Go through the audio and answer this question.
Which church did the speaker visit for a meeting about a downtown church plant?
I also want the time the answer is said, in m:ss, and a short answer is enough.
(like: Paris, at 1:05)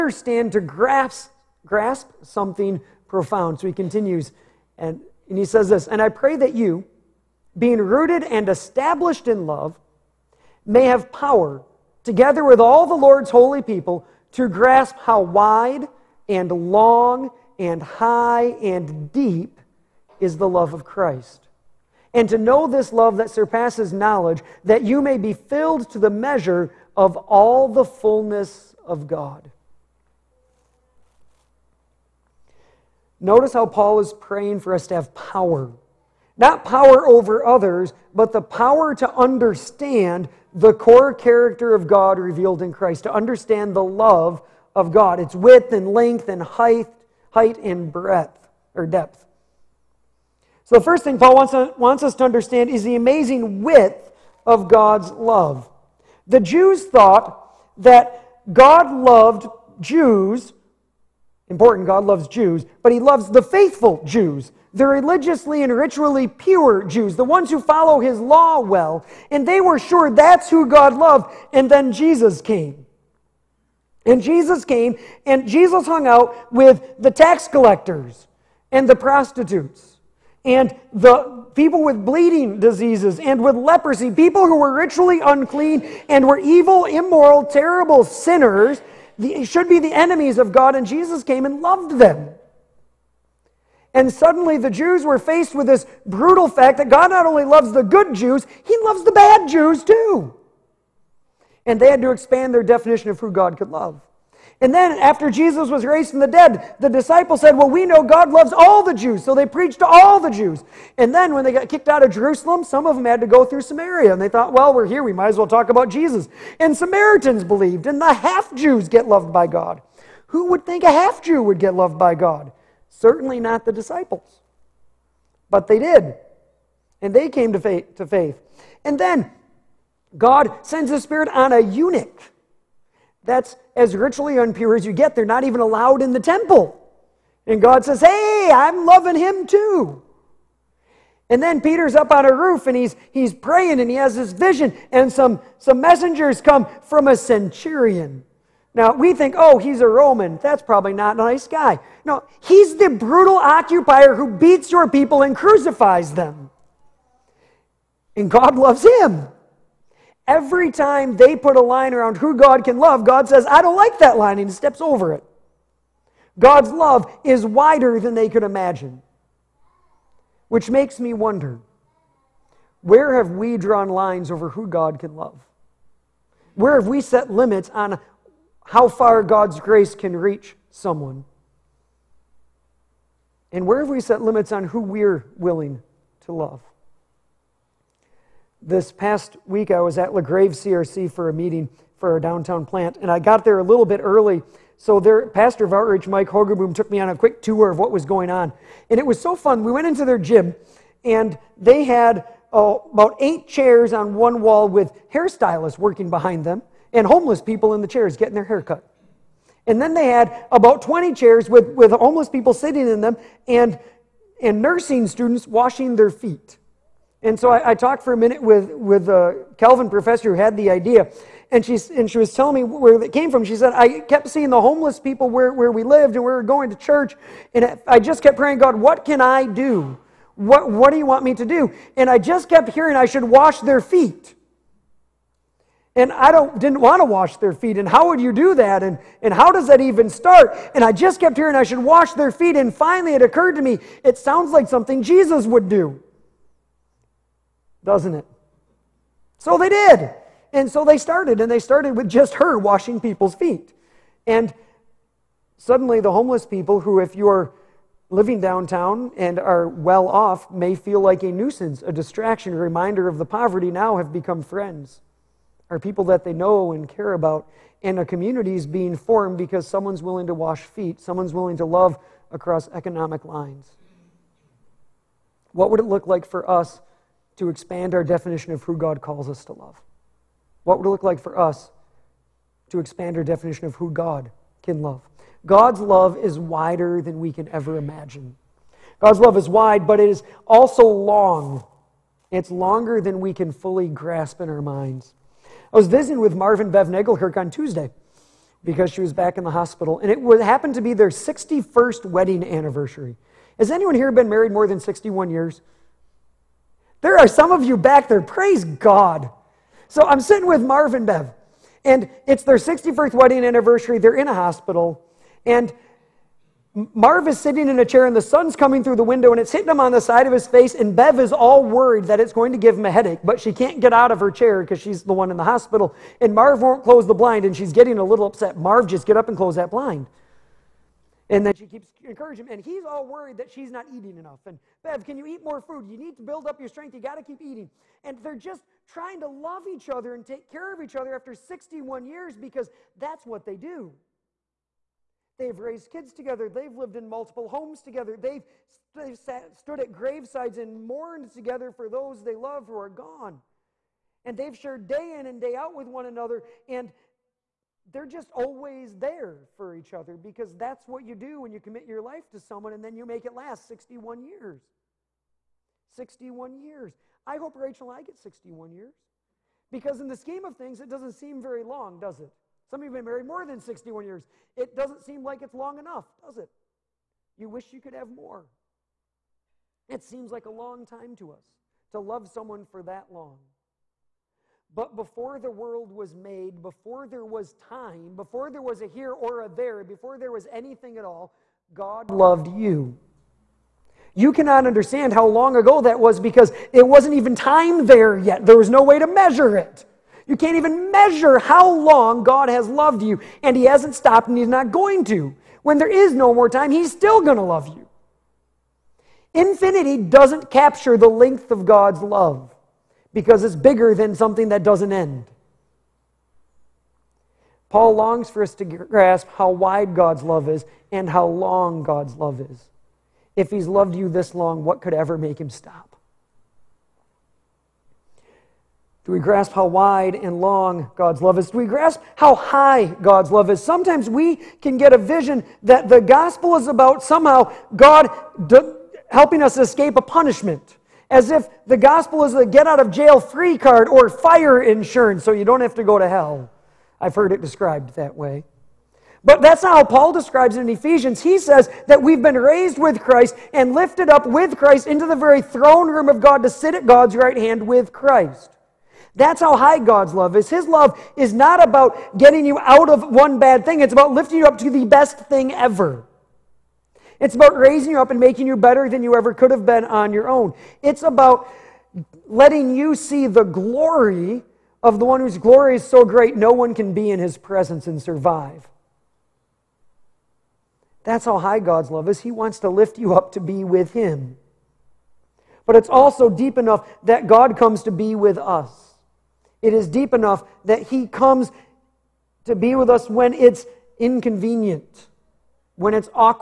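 LaGrave CRC, at 3:10.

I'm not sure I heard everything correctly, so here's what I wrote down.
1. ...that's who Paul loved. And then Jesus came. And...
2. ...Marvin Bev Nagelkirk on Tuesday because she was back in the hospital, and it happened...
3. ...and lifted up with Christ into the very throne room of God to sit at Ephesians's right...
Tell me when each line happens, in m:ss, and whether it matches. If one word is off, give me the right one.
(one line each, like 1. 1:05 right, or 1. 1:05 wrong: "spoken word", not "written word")
1. 1:10 wrong: "God", not "Paul"
2. 4:56 right
3. 7:33 wrong: "God", not "Ephesians".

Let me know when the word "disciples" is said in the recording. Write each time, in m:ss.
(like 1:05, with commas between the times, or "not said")
1:46, 2:03.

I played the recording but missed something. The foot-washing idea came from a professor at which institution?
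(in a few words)
Calvin.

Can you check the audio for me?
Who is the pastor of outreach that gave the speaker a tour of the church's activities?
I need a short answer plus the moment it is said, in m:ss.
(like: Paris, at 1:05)
Mike Hogerboom, at 3:16.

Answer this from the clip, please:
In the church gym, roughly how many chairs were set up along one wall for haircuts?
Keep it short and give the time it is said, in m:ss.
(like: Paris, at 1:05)
8, at 3:23.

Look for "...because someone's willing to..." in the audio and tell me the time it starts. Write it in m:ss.
4:29.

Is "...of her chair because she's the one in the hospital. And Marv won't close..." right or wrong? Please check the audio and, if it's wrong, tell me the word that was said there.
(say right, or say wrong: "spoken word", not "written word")
right.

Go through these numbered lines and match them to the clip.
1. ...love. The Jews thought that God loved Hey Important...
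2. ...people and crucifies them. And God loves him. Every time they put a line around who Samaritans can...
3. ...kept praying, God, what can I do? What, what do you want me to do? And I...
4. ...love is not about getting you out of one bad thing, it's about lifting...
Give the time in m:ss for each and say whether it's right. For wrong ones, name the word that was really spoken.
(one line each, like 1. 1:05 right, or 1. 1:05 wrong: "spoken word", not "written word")
1. 0:55 wrong: "Jews", not "Hey"
2. 2:34 wrong: "God", not "Samaritans"
3. 3:48 right
4. 7:40 right.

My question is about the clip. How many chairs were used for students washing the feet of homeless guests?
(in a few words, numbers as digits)
20.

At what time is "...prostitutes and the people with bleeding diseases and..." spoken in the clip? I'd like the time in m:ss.
1:18.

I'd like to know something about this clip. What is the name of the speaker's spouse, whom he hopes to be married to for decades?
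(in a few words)
Rachel.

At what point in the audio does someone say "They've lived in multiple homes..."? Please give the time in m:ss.
5:46.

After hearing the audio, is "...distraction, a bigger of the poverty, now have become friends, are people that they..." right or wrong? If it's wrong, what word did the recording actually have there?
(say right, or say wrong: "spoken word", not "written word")
wrong: "reminder", not "bigger".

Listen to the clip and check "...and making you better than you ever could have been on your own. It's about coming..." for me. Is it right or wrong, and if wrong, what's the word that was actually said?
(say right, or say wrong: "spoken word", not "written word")
wrong: "letting", not "coming".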